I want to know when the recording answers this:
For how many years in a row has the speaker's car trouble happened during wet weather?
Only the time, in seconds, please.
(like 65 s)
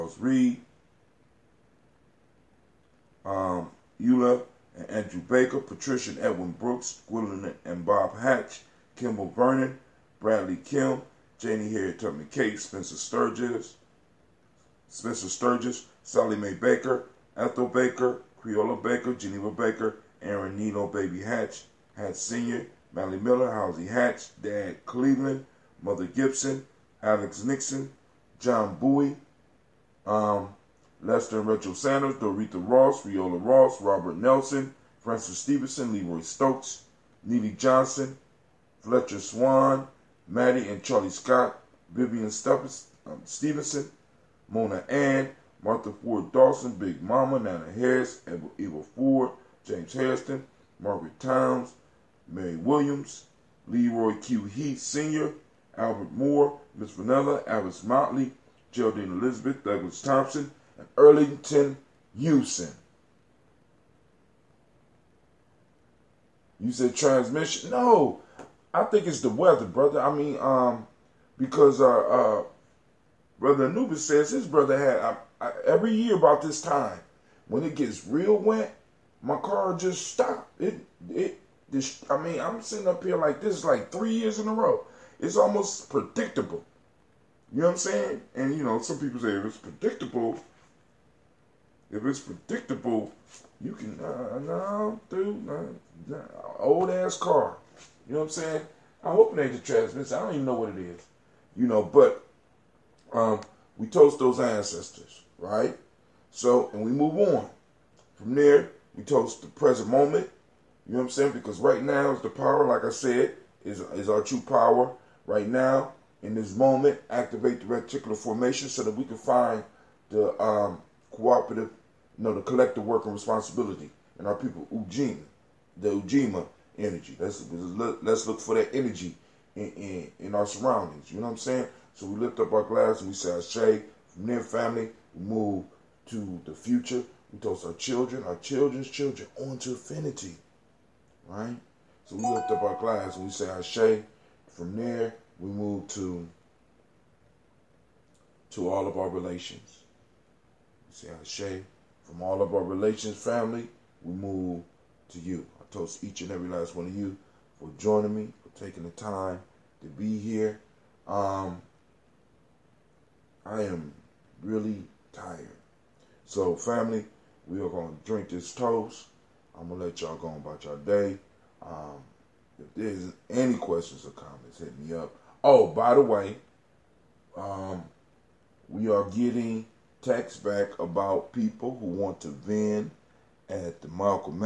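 83 s.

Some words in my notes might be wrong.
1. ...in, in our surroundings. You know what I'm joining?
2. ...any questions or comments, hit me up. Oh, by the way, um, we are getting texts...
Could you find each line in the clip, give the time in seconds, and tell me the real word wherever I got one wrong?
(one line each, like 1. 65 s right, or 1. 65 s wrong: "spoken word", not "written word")
1. 129 s wrong: "saying", not "joining"
2. 173 s right.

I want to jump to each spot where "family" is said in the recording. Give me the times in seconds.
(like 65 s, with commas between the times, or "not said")
134 s, 153 s, 166 s.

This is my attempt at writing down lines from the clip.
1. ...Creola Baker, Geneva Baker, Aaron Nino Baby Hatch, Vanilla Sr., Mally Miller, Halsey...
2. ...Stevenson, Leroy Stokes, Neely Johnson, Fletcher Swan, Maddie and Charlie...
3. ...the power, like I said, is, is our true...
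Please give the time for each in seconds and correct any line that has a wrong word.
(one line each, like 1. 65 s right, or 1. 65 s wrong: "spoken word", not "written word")
1. 18 s wrong: "Hatch", not "Vanilla"
2. 35 s right
3. 112 s right.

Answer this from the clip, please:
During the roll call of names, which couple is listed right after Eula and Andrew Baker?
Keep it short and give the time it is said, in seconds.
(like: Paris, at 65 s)
Patricia and Edwin Brooks, at 5 s.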